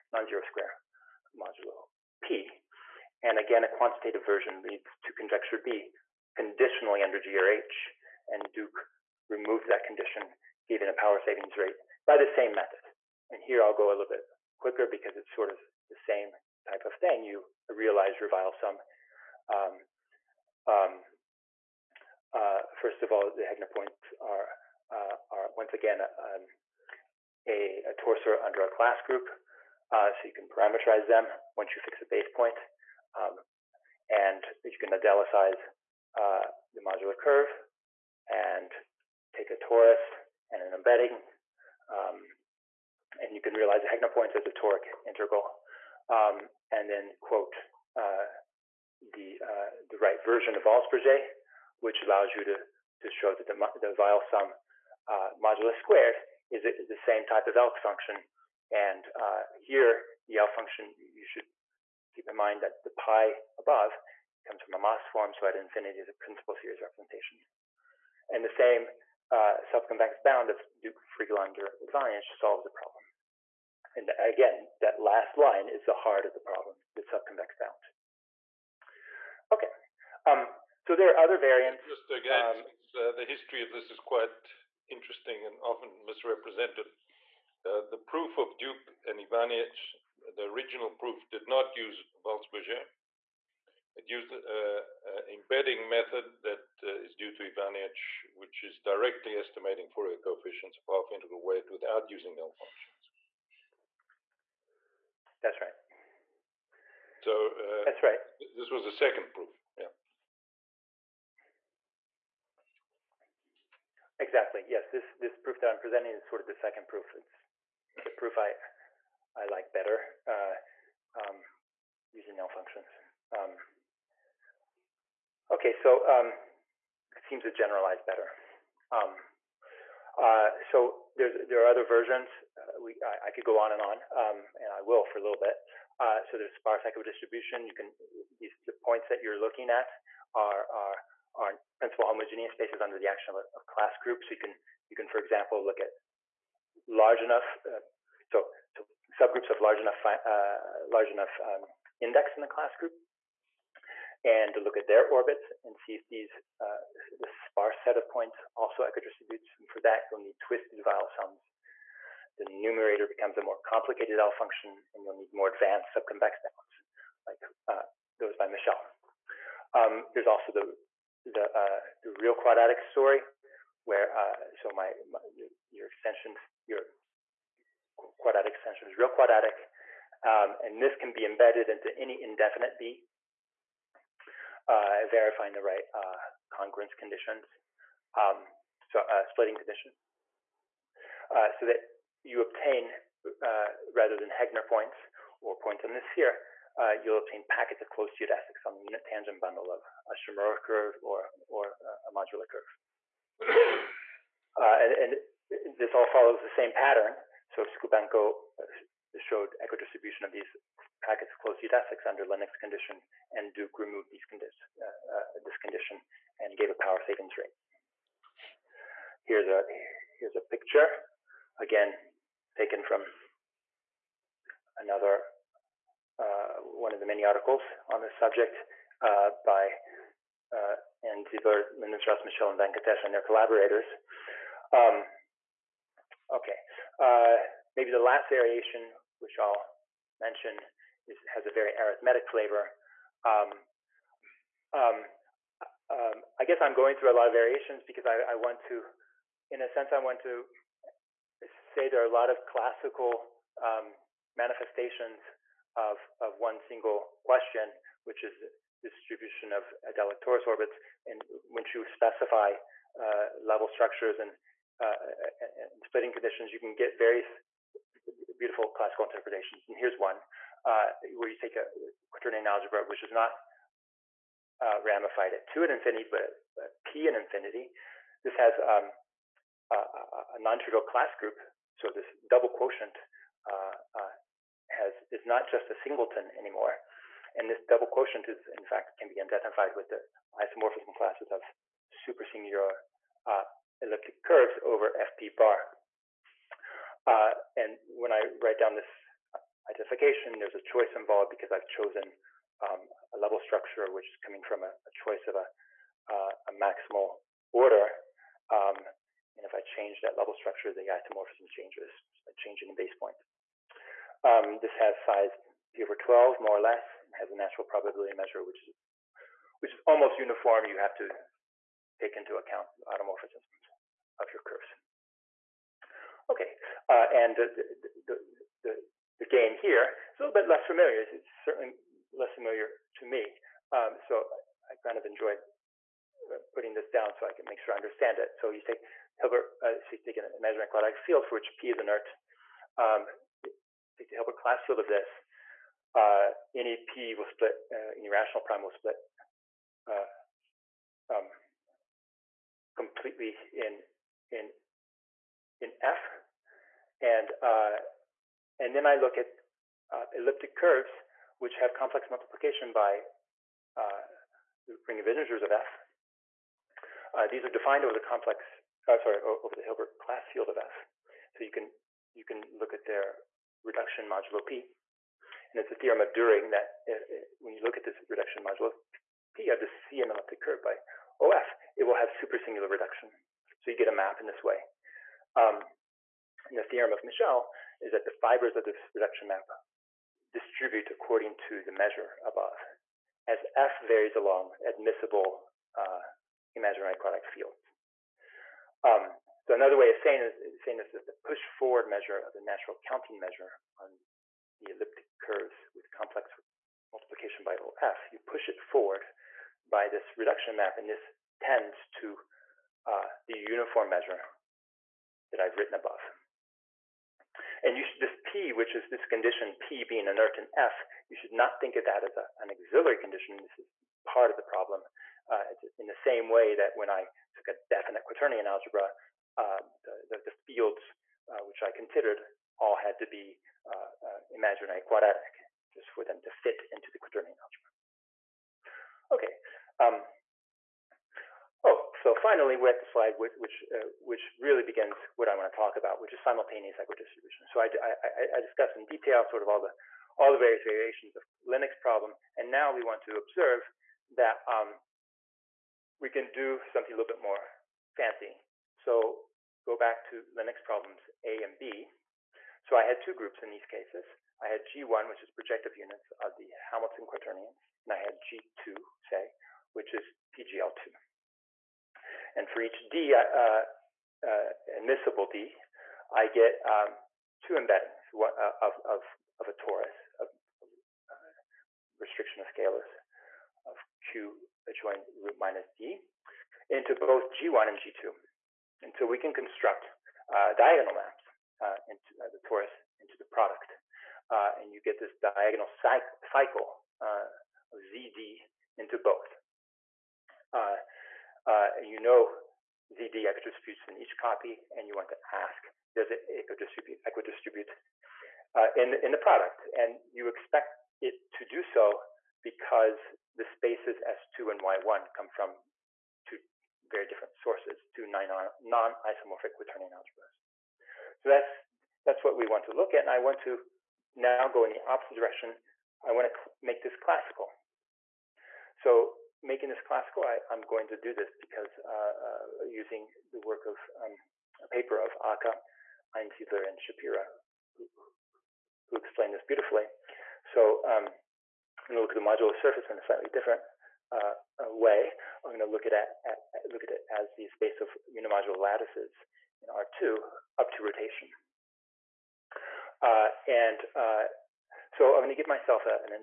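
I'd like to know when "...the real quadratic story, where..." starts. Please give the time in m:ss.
2:52.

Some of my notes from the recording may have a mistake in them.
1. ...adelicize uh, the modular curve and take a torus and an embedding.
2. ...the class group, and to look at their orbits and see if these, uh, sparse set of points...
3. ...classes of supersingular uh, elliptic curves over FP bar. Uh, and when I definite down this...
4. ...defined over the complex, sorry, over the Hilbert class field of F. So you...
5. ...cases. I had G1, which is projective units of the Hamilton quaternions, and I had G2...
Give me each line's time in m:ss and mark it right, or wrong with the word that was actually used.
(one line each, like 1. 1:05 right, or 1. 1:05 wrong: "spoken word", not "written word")
1. 0:34 right
2. 2:32 right
3. 4:50 wrong: "write", not "definite"
4. 6:07 right
5. 7:43 right.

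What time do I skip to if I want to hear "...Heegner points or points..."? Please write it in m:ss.
3:14.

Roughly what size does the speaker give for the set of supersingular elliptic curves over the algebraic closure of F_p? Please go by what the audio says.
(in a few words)
P over 12.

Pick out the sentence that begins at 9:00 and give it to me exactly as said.
So um, I'm going to look at the modular surface in a slightly different uh, uh way.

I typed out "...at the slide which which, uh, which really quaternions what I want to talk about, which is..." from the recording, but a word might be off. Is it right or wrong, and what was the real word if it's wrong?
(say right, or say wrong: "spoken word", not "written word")
wrong: "begins", not "quaternions".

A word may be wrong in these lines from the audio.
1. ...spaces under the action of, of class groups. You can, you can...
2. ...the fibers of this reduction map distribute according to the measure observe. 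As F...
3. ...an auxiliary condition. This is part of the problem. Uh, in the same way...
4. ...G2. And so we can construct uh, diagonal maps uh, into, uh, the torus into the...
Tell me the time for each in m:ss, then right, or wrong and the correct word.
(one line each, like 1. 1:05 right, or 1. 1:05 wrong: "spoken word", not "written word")
1. 2:22 right
2. 6:28 wrong: "above", not "observe"
3. 7:02 right
4. 8:07 right.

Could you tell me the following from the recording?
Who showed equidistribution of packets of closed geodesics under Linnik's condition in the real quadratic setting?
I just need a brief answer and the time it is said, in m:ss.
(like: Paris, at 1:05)
Skubenko, at 3:27.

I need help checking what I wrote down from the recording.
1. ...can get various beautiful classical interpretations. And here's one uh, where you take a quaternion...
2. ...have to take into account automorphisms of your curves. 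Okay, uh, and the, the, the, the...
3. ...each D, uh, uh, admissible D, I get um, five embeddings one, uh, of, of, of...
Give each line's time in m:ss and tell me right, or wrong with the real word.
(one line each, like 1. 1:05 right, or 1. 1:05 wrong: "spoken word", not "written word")
1. 4:26 right
2. 5:20 right
3. 7:52 wrong: "two", not "five".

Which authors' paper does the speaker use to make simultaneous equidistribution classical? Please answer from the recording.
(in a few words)
Aka, Einsiedler, and Shapira.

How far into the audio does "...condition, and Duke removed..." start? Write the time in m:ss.
3:32.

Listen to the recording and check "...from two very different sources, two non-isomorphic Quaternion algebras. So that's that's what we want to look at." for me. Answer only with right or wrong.
right.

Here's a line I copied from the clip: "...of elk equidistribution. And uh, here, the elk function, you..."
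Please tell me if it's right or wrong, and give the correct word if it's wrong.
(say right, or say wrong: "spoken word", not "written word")
wrong: "function", not "equidistribution".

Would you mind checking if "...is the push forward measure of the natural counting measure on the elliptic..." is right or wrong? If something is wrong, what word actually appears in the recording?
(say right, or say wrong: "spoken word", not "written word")
right.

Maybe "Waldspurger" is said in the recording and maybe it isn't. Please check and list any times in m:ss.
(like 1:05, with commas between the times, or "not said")
0:50, 1:32.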